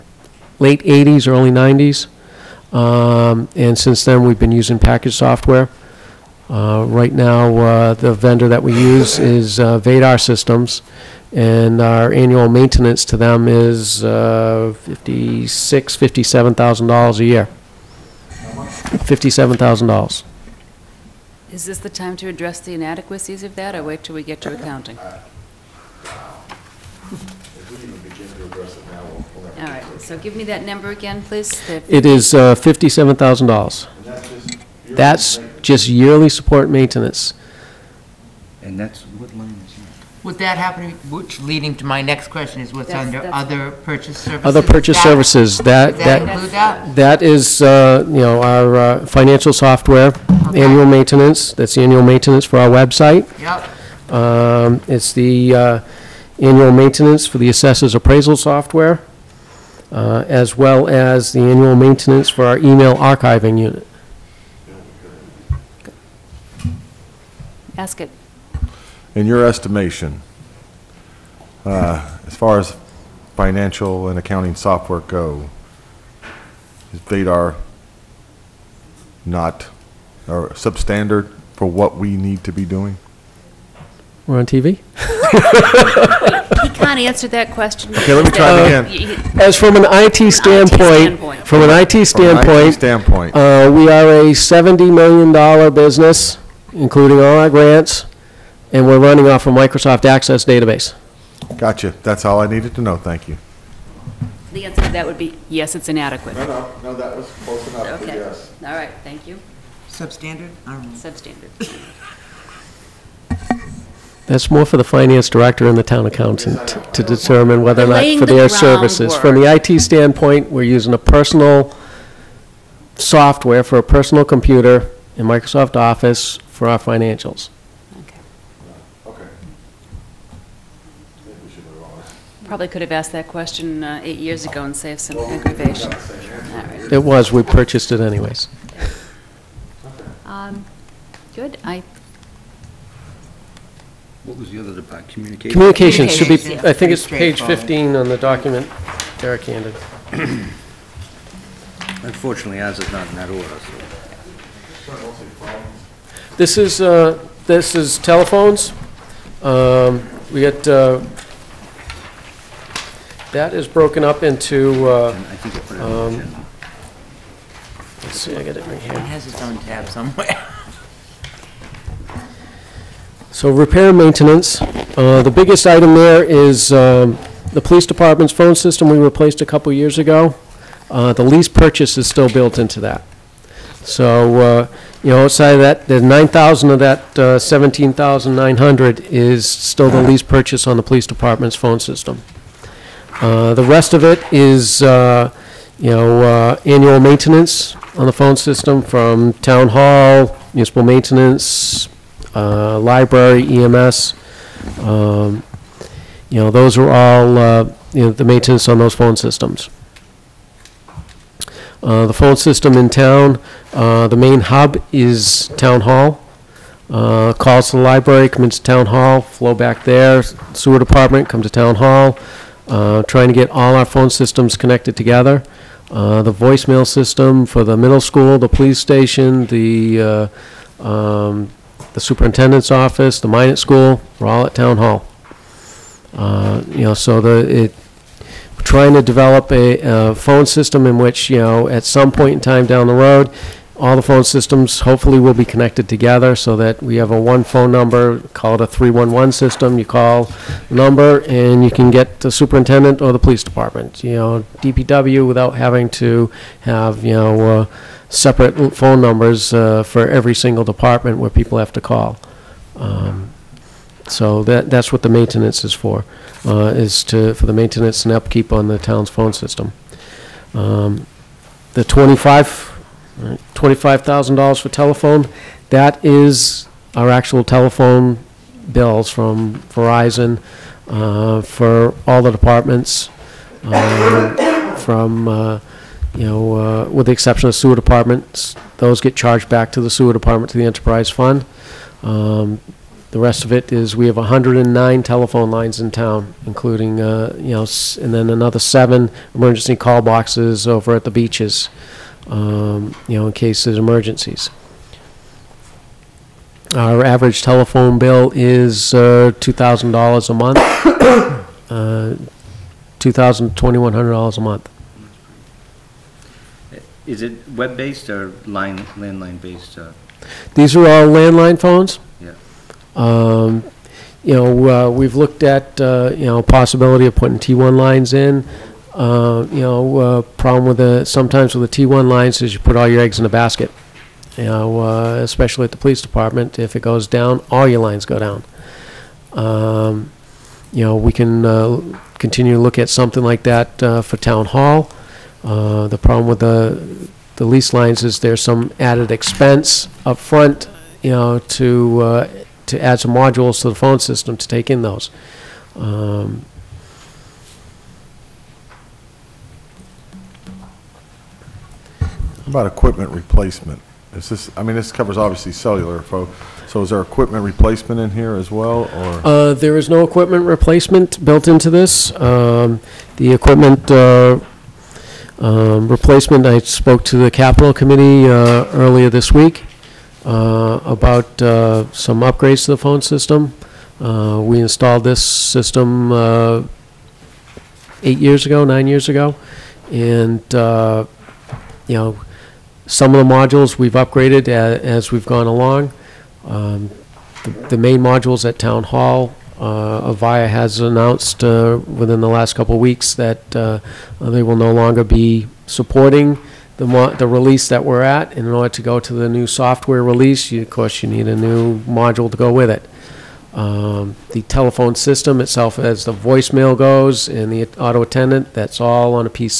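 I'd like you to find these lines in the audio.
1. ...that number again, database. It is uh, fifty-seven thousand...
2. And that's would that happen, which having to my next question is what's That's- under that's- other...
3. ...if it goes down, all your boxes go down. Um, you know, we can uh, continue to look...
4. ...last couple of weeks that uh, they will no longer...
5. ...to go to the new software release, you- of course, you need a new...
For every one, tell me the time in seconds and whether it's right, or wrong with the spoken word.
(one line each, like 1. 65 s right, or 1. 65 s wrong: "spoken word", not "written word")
1. 30 s wrong: "please", not "database"
2. 38 s wrong: "leading", not "having"
3. 336 s wrong: "lines", not "boxes"
4. 402 s right
5. 408 s right.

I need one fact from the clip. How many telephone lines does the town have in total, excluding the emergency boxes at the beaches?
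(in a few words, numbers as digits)
109.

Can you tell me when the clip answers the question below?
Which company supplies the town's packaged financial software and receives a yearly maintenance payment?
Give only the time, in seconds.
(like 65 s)
9 s.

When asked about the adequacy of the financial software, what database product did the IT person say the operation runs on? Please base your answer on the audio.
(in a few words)
Microsoft Access.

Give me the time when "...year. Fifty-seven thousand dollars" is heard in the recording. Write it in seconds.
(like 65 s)
17 s.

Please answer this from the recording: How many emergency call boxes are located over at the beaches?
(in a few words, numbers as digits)
7.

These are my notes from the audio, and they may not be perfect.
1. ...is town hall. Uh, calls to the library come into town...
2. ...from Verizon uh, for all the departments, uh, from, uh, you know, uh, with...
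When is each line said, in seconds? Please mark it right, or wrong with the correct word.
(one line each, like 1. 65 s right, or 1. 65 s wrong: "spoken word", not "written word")
1. 214 s right
2. 279 s right.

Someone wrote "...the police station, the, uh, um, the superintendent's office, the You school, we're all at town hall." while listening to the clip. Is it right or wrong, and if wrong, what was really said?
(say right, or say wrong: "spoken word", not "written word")
wrong: "Minot", not "You".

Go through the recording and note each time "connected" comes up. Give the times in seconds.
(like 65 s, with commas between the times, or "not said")
224 s, 245 s.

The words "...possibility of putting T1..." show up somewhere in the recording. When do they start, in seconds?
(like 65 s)
326 s.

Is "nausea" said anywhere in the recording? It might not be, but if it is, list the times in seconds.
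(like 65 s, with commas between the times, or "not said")
not said.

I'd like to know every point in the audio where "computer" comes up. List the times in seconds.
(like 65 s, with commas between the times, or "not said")
124 s.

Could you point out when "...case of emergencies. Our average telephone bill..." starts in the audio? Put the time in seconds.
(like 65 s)
303 s.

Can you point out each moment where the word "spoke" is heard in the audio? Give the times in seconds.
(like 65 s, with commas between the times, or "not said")
376 s.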